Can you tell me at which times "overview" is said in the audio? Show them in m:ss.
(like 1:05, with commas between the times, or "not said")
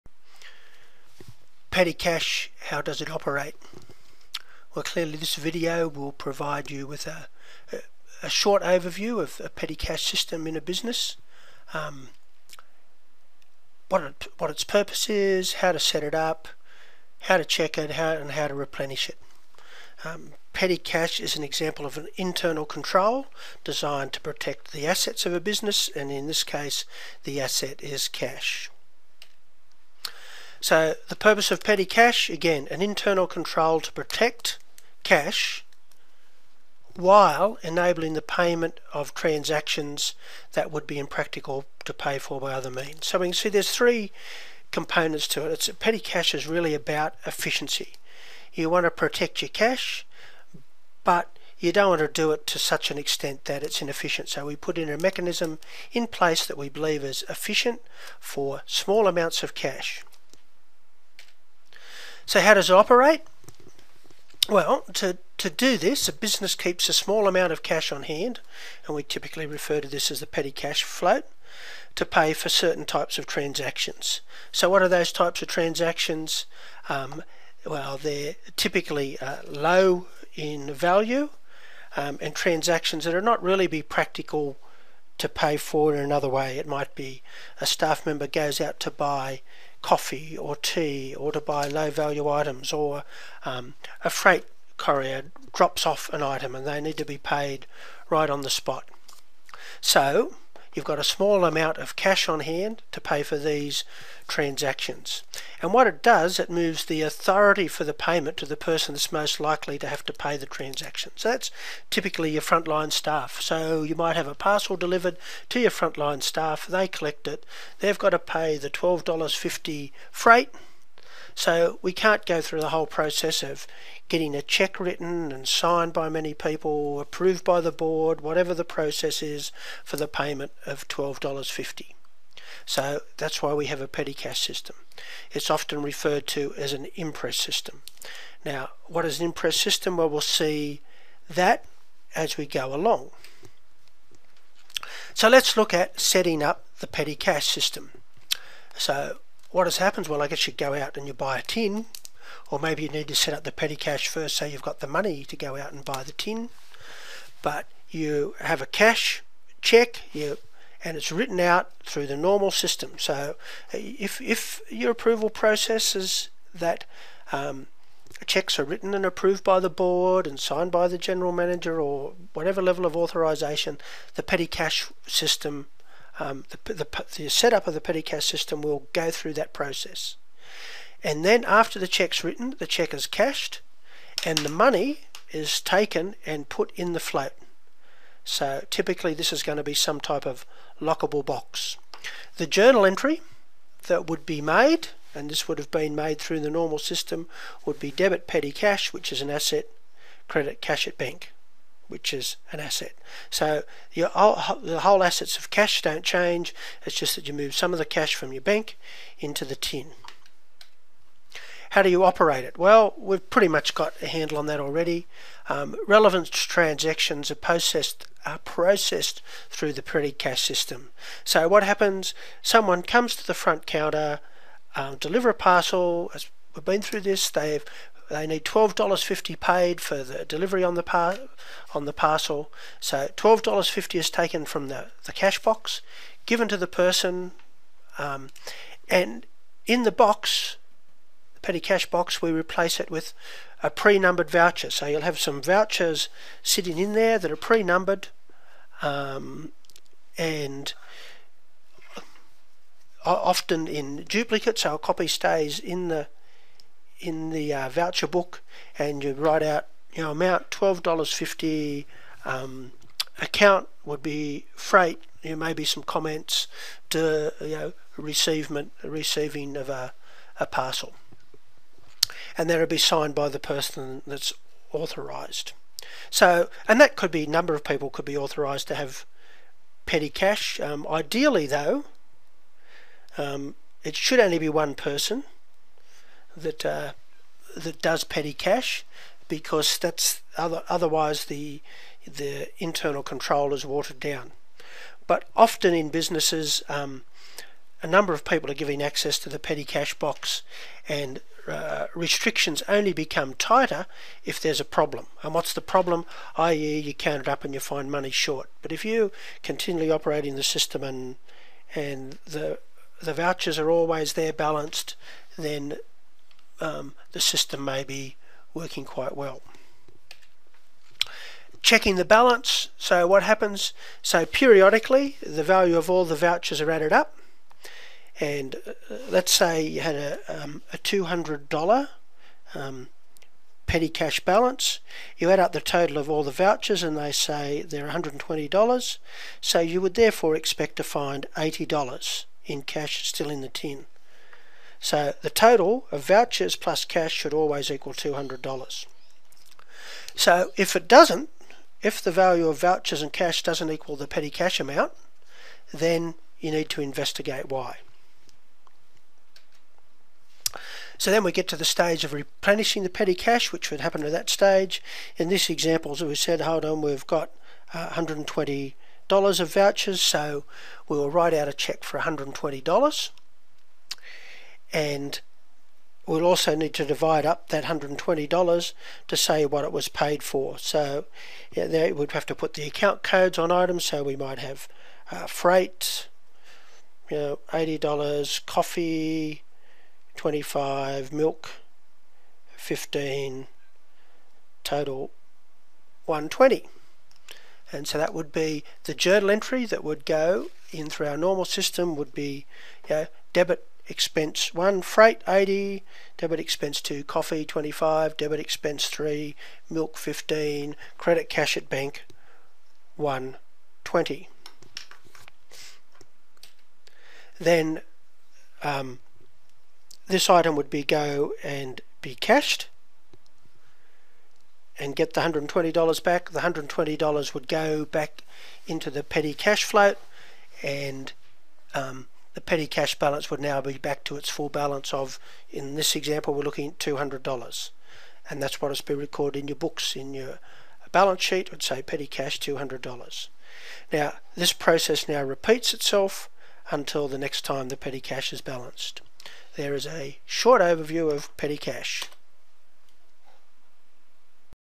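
0:08, 7:30.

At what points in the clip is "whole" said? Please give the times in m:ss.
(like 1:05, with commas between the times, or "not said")
2:02, 3:24.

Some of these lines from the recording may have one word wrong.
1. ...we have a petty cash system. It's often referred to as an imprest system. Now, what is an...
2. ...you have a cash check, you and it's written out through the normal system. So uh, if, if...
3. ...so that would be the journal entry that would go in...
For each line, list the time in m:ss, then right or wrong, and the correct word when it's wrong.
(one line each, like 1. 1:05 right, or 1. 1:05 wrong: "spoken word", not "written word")
1. 2:13 right
2. 2:37 right
3. 6:37 right.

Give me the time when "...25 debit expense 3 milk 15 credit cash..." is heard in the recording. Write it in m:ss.
6:47.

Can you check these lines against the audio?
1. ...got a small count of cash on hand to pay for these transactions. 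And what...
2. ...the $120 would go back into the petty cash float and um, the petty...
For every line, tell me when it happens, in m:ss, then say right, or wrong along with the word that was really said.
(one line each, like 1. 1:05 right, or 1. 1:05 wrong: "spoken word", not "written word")
1. 1:40 wrong: "amount", not "count"
2. 7:06 right.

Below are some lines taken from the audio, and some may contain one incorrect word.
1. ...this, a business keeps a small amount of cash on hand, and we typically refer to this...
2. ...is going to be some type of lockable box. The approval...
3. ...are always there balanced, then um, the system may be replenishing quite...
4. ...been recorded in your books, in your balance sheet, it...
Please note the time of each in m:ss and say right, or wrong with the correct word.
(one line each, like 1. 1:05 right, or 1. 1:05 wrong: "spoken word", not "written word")
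1. 1:05 right
2. 3:09 wrong: "journal", not "approval"
3. 5:13 wrong: "working", not "replenishing"
4. 7:18 right.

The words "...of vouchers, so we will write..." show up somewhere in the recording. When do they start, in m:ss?
6:09.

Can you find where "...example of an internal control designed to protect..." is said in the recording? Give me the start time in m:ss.
0:21.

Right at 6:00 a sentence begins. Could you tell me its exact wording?
So then we get to the stage of replenishing the petty cash, which would happen at that stage.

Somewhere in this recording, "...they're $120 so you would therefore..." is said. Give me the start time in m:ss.
5:37.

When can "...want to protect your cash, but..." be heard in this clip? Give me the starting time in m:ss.
0:48.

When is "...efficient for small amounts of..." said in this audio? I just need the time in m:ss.
0:57.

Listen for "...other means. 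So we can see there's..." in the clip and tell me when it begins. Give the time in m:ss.
0:42.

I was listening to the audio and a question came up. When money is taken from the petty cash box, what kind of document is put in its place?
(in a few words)
pre-numbered voucher.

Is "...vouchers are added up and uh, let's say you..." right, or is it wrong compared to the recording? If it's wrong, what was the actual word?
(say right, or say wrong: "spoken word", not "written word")
right.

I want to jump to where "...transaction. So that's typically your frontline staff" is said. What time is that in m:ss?
1:50.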